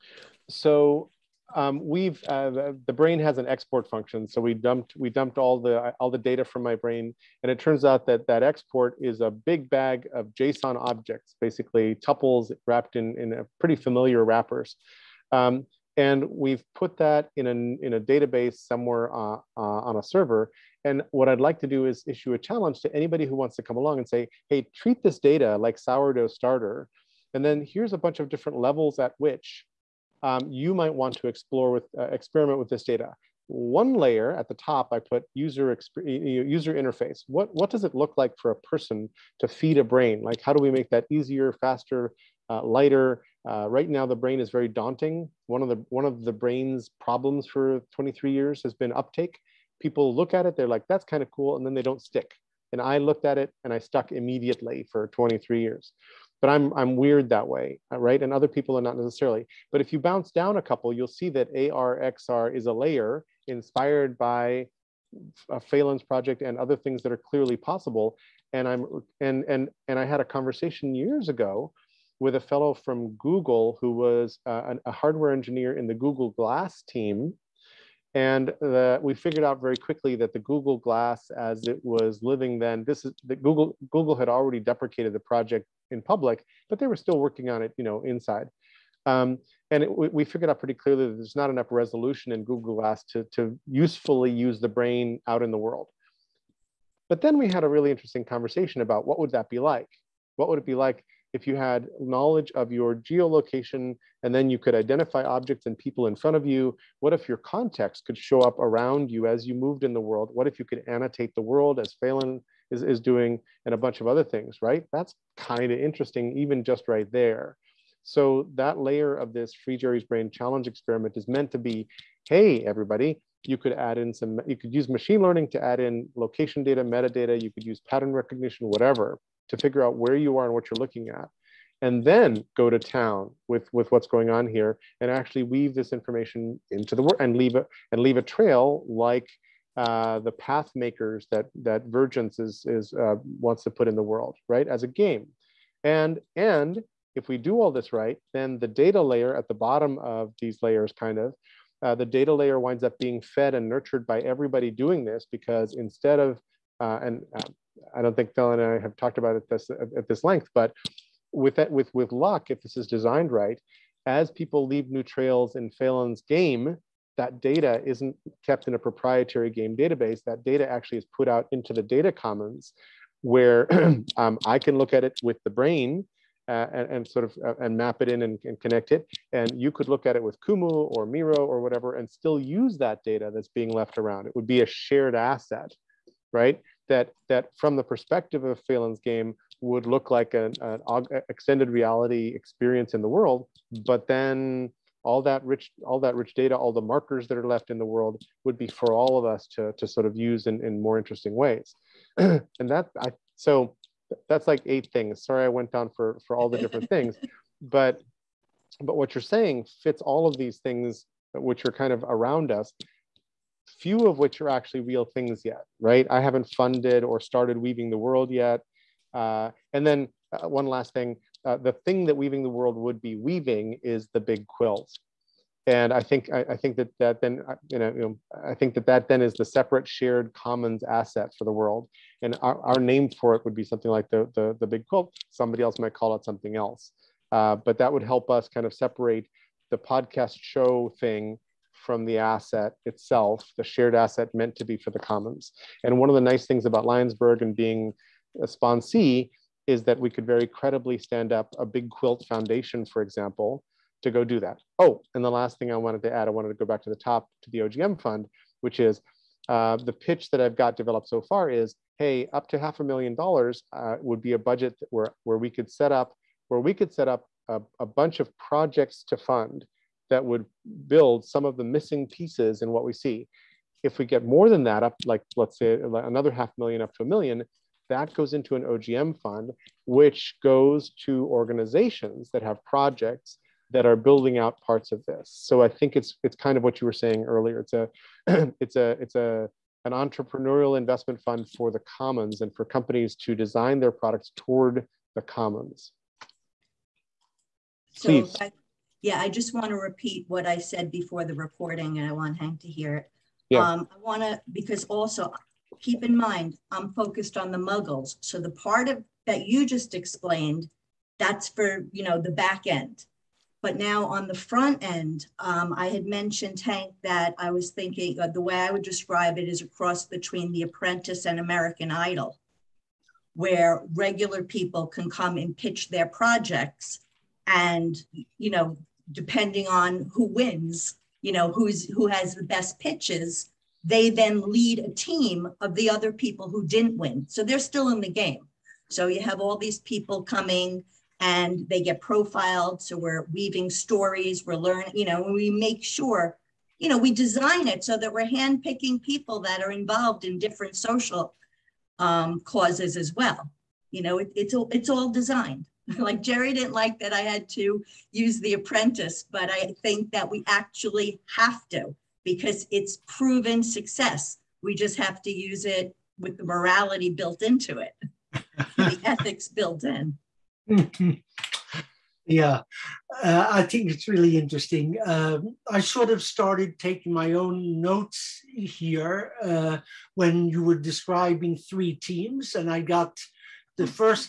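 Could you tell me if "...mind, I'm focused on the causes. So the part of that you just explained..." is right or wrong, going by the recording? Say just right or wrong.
wrong.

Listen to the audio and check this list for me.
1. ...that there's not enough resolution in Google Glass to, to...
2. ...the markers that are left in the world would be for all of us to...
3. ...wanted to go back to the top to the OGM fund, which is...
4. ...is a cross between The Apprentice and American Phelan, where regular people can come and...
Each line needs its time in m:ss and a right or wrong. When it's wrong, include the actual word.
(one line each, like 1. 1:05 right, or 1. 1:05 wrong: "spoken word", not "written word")
1. 1:31 right
2. 3:16 right
3. 4:16 right
4. 5:19 wrong: "Idol", not "Phelan".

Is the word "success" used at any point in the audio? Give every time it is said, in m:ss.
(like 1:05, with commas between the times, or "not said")
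6:03.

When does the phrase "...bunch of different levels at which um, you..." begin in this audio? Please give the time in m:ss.
0:27.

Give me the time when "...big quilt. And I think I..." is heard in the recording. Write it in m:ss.
3:44.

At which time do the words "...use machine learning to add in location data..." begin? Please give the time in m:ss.
2:04.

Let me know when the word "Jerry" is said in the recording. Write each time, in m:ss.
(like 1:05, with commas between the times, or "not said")
1:59, 5:56.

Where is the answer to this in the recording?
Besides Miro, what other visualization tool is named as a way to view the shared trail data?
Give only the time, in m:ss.
3:00.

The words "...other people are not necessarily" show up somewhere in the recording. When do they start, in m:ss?
0:58.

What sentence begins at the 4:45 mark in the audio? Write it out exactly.
So I think it's it's kind of what you were saying earlier.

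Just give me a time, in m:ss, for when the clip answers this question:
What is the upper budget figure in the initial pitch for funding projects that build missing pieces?
4:22.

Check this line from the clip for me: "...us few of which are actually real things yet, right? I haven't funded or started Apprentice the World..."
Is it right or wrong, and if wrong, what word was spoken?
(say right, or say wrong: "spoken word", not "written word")
wrong: "Weaving", not "Apprentice".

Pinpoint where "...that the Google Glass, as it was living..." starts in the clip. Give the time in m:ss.
1:20.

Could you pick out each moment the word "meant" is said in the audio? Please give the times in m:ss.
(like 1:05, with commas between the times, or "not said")
2:01, 4:04.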